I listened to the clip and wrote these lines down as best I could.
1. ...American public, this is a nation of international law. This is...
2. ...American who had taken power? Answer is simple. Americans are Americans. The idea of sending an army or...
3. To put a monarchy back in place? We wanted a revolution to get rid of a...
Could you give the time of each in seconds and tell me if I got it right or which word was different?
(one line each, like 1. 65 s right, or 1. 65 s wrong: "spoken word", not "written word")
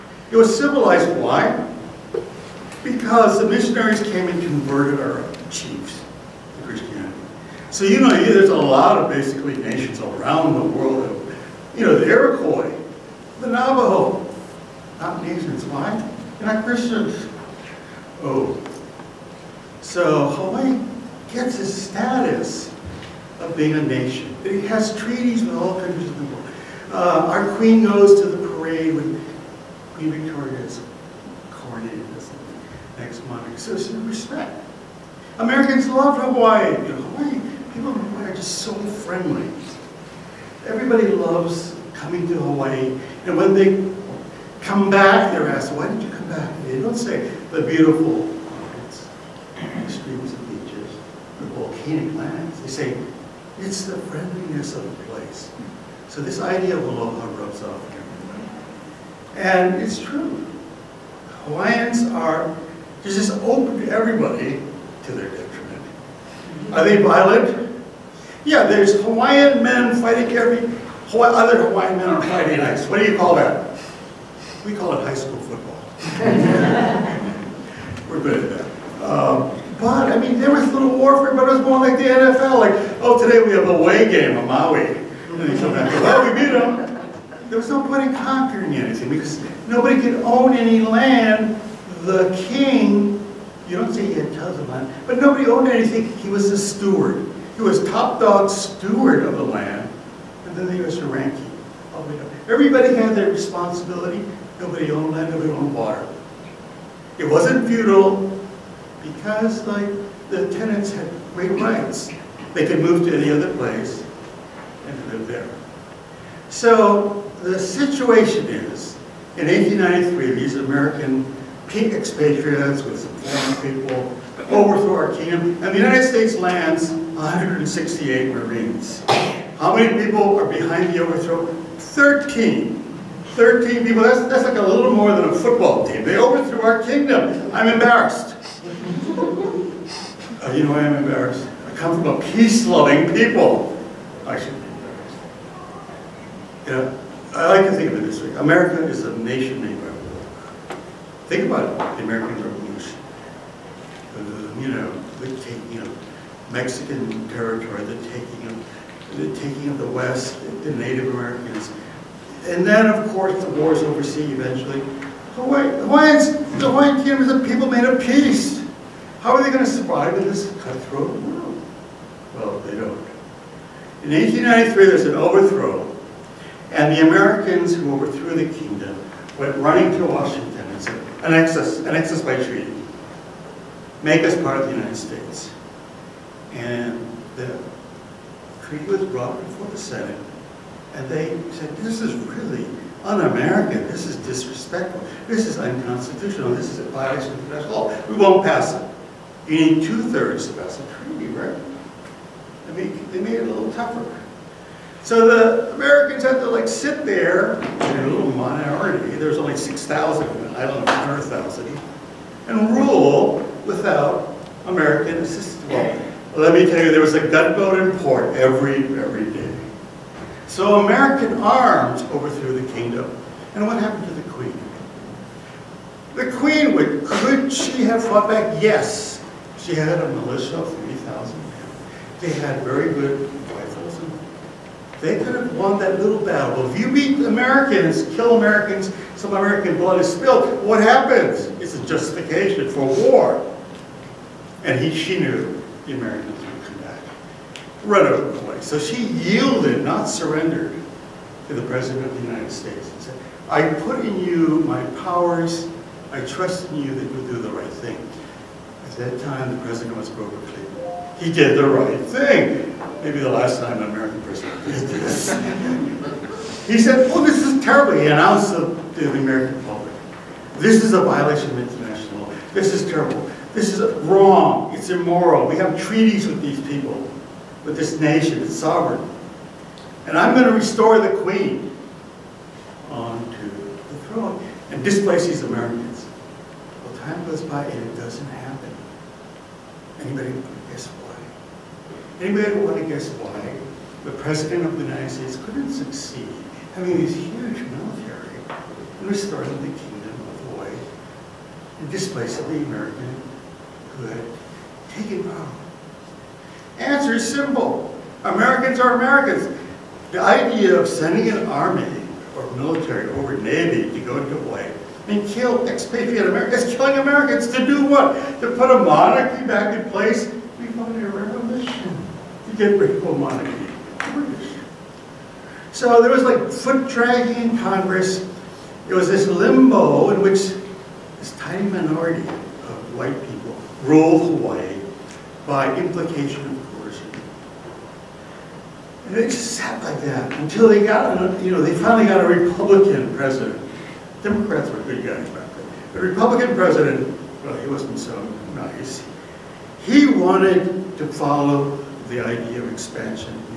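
1. 269 s wrong: "violation", not "nation"
2. 302 s right
3. 318 s right.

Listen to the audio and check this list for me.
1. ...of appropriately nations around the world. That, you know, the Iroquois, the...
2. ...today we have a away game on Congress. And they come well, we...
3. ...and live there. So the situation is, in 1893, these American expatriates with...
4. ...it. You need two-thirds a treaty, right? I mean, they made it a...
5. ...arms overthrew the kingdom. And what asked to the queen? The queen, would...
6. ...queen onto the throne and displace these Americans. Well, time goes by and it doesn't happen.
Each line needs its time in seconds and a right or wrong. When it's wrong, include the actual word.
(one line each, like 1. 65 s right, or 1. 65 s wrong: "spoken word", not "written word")
1. 8 s wrong: "basically", not "appropriately"
2. 83 s wrong: "Maui", not "Congress"
3. 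114 s right
4. 198 s right
5. 221 s wrong: "happened", not "asked"
6. 281 s right.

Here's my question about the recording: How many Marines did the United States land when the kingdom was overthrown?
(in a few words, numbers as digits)
168.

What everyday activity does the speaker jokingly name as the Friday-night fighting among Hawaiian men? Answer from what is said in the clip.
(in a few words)
high school football.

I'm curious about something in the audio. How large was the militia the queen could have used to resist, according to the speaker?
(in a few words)
3,000 men.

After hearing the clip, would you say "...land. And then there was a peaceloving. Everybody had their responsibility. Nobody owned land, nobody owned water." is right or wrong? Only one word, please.
wrong.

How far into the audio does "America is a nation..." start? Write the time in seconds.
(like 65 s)
148 s.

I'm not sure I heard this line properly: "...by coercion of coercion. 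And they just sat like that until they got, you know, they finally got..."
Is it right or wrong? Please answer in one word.
wrong.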